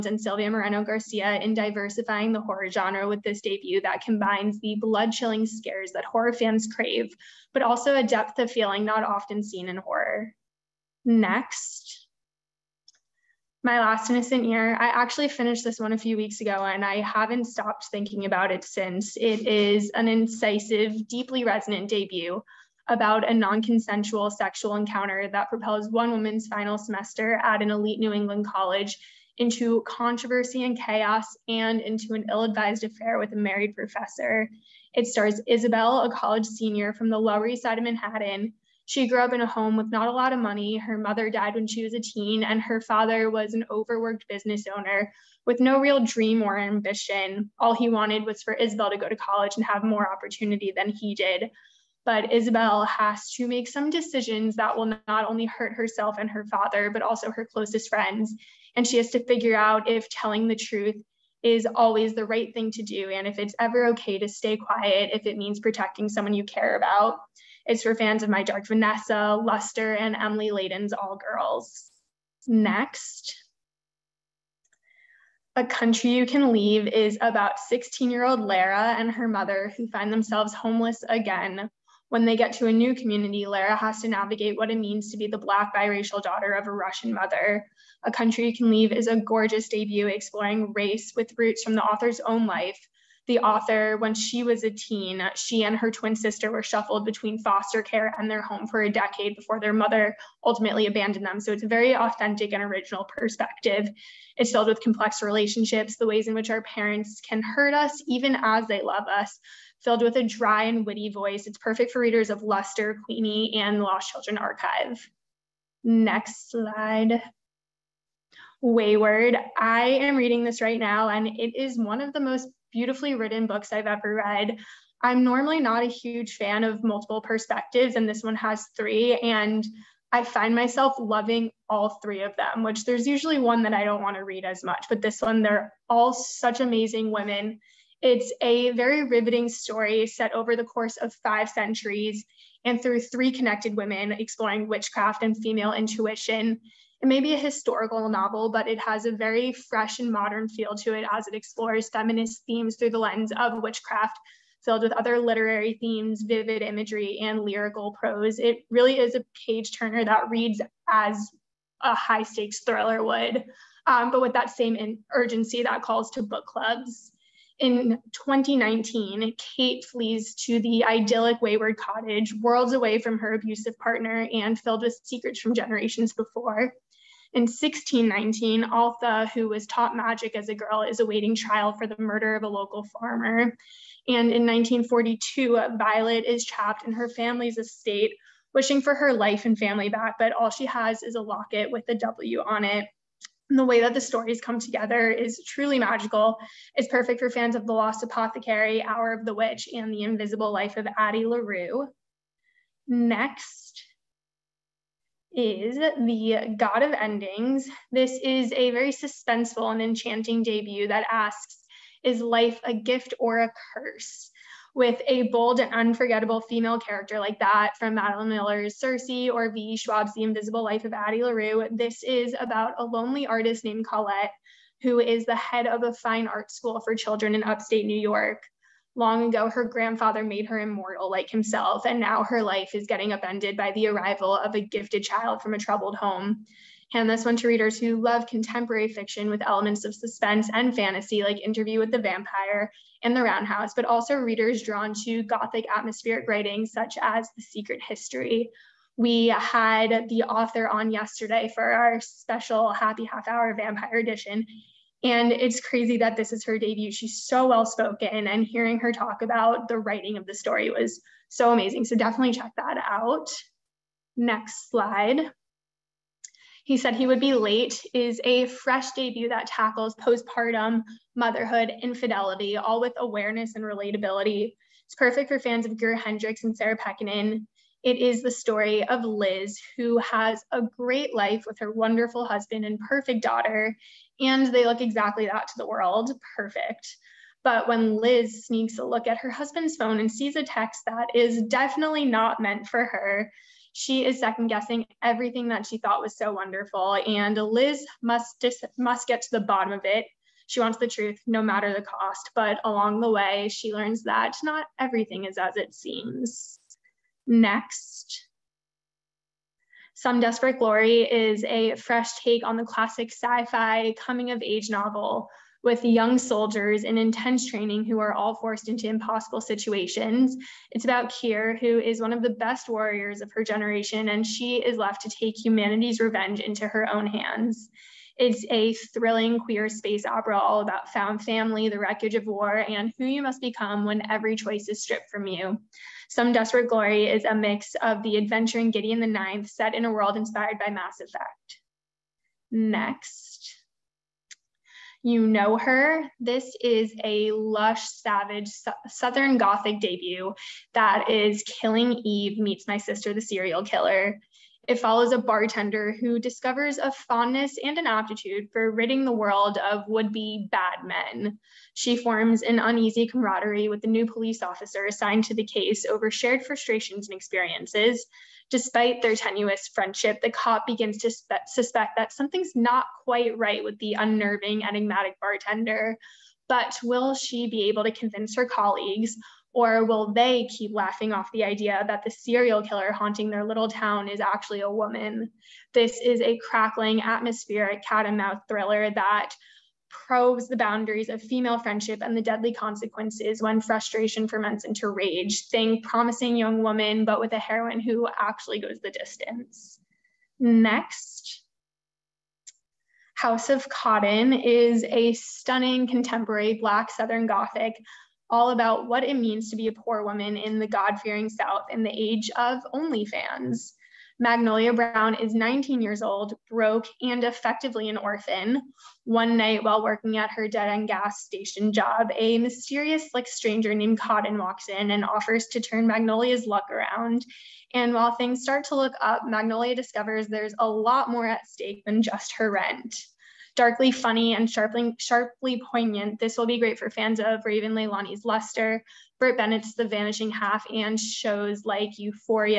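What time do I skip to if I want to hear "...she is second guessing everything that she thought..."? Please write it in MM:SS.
04:53.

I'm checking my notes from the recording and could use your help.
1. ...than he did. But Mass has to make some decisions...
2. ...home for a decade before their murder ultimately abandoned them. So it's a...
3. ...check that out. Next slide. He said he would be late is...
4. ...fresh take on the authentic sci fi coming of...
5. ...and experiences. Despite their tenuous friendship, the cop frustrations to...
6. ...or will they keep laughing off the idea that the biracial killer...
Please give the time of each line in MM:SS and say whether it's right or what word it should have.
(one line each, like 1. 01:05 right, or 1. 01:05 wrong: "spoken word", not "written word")
1. 00:50 wrong: "Isabel", not "Mass"
2. 01:38 wrong: "mother", not "murder"
3. 04:22 right
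4. 05:11 wrong: "classic", not "authentic"
5. 06:07 wrong: "begins", not "frustrations"
6. 06:19 wrong: "serial", not "biracial".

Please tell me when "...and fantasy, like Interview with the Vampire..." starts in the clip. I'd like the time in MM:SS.
04:00.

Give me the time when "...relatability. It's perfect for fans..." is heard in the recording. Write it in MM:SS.
04:33.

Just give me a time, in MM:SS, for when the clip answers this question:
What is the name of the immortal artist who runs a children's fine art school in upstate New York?
03:43.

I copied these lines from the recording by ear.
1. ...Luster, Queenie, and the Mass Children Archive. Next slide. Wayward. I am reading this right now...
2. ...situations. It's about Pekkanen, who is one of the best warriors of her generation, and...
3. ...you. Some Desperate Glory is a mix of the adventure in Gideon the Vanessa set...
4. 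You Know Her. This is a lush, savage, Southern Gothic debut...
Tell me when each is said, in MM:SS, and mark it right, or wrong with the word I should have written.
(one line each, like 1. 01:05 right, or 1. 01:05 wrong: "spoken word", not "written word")
1. 01:52 wrong: "Lost", not "Mass"
2. 05:19 wrong: "Kyr", not "Pekkanen"
3. 05:35 wrong: "Ninth", not "Vanessa"
4. 05:45 right.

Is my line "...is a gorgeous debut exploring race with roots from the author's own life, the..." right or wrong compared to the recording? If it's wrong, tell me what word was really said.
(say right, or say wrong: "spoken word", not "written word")
right.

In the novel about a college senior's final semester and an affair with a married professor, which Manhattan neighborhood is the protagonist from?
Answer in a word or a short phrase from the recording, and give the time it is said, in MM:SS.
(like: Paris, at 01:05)
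Lower East Side, at 00:37.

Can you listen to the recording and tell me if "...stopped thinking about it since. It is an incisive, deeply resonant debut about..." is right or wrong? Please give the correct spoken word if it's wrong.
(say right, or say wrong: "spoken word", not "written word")
right.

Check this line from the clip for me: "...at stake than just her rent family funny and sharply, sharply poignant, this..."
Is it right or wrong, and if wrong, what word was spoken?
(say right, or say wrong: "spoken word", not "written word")
wrong: "darkly", not "family".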